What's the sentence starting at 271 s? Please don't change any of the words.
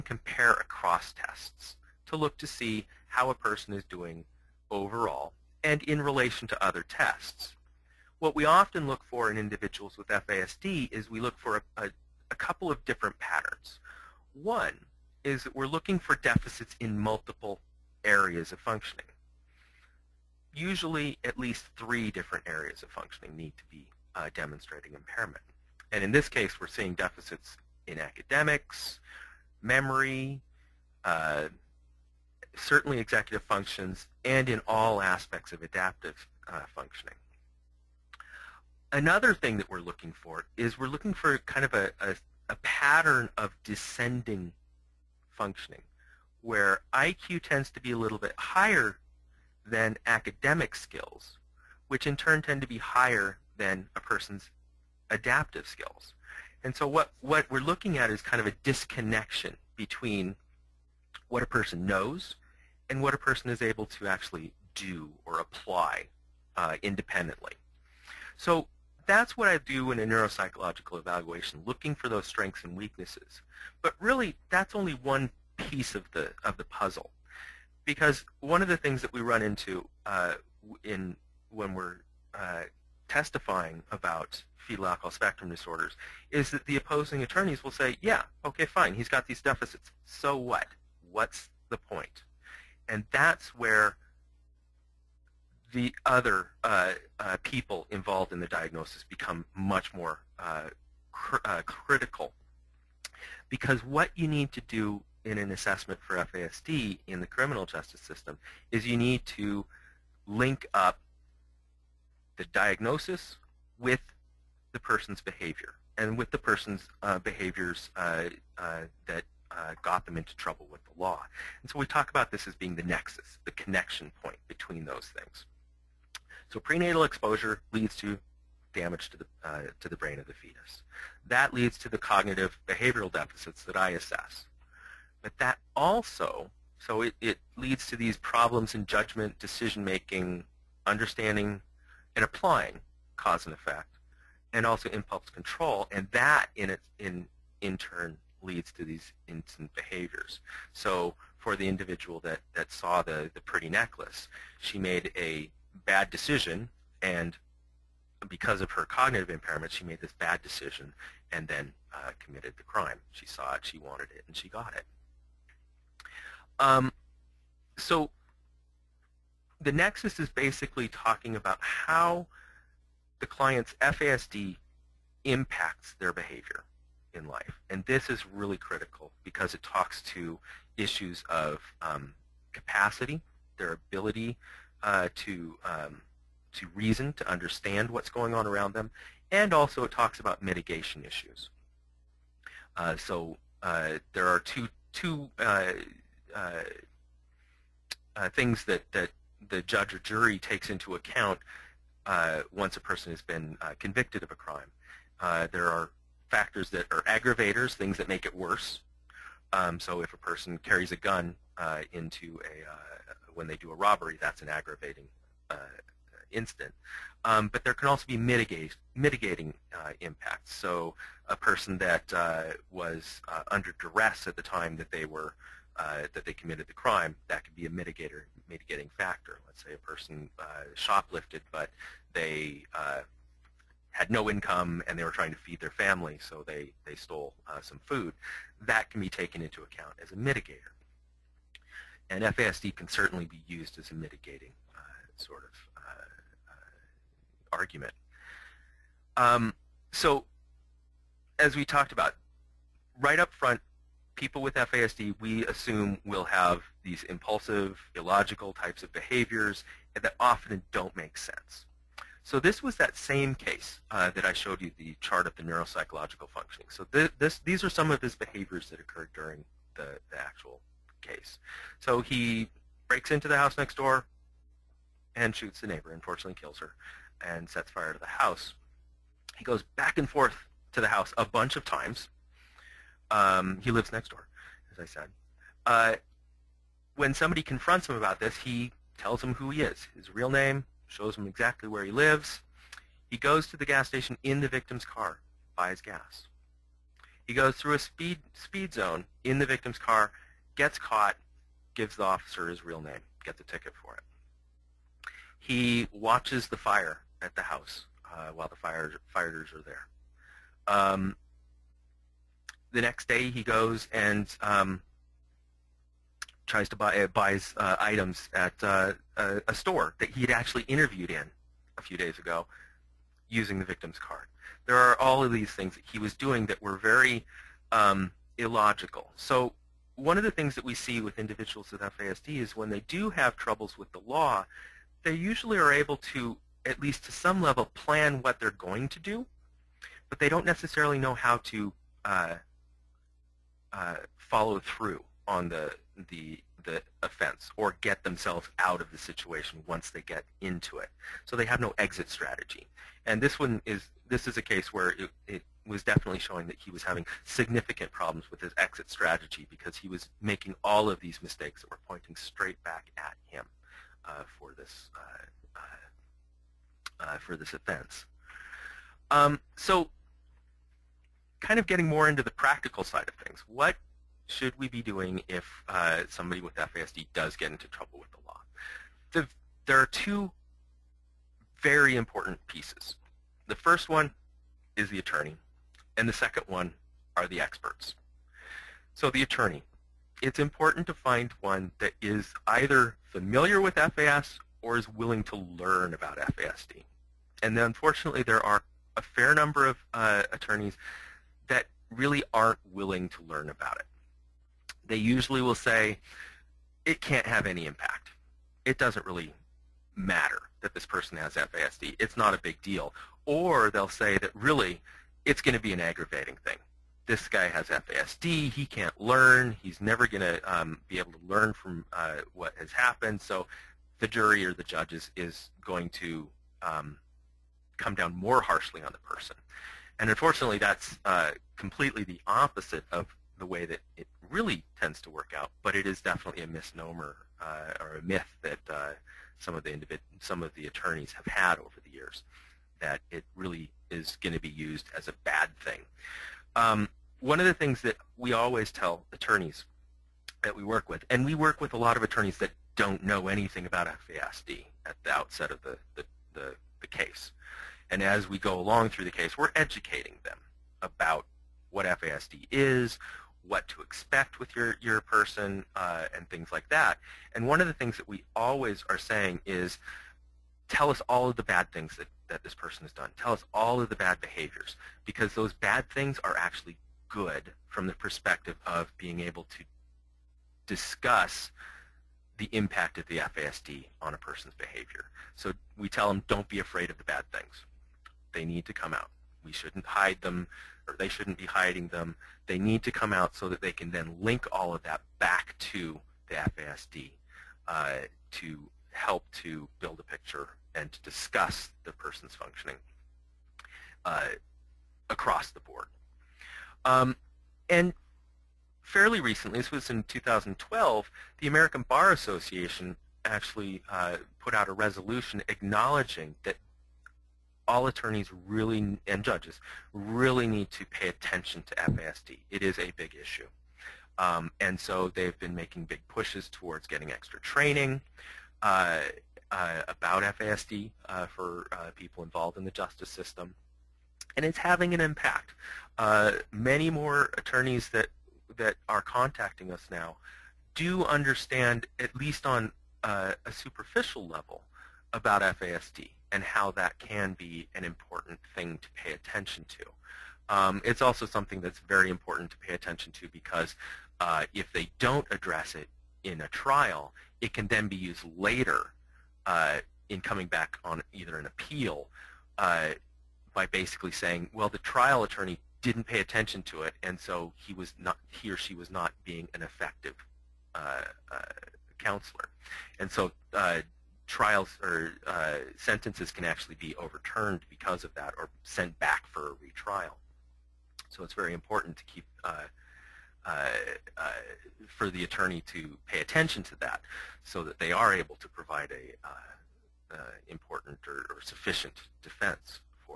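So he breaks into the house next door and shoots the neighbor, unfortunately kills her, and sets fire to the house.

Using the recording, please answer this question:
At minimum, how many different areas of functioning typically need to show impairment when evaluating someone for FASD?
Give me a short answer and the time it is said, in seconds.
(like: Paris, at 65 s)
3, at 21 s.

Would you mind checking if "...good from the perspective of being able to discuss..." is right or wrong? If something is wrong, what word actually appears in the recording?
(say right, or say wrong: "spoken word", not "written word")
right.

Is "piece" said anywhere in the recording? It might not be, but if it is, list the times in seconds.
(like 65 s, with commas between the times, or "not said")
75 s, 382 s.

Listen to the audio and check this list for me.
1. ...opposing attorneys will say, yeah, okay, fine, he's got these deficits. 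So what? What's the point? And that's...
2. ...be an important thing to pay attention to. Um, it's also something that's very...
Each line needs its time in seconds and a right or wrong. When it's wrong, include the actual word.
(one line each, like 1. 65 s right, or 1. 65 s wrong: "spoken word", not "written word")
1. 86 s right
2. 547 s right.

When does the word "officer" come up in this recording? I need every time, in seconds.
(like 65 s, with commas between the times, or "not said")
302 s.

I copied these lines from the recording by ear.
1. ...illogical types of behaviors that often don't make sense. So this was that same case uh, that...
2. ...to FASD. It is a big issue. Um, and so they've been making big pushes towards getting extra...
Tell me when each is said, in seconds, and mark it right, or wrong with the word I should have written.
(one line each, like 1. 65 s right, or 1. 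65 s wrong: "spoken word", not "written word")
1. 257 s right
2. 521 s right.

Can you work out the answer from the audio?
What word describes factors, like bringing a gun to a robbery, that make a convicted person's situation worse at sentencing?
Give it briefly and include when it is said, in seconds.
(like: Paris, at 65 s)
aggravators, at 207 s.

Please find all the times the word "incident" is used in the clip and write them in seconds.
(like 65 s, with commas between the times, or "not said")
216 s.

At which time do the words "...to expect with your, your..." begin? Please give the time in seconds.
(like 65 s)
463 s.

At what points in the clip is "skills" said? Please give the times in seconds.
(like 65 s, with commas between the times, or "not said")
50 s, 55 s.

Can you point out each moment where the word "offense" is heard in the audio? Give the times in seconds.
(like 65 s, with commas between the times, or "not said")
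347 s, 367 s.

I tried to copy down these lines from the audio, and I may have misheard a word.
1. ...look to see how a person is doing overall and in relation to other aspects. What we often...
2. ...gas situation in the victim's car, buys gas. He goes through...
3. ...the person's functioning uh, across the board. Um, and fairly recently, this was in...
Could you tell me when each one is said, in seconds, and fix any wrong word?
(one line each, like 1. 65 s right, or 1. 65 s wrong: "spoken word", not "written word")
1. 2 s wrong: "tests", not "aspects"
2. 293 s wrong: "station", not "situation"
3. 501 s right.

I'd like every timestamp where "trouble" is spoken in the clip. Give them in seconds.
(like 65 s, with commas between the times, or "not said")
120 s, 333 s, 377 s.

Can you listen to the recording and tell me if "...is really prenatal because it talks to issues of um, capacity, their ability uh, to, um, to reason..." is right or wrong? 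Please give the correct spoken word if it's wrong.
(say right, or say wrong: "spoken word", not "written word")
wrong: "critical", not "prenatal".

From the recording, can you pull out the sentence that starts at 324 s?
There are all of these things that he was doing that were very um, illogical.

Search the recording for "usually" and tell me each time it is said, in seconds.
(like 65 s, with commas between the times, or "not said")
20 s, 335 s, 404 s.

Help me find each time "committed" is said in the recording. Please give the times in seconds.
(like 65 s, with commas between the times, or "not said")
162 s, 226 s.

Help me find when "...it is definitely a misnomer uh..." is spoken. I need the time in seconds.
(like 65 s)
435 s.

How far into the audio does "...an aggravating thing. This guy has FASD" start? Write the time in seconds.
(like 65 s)
415 s.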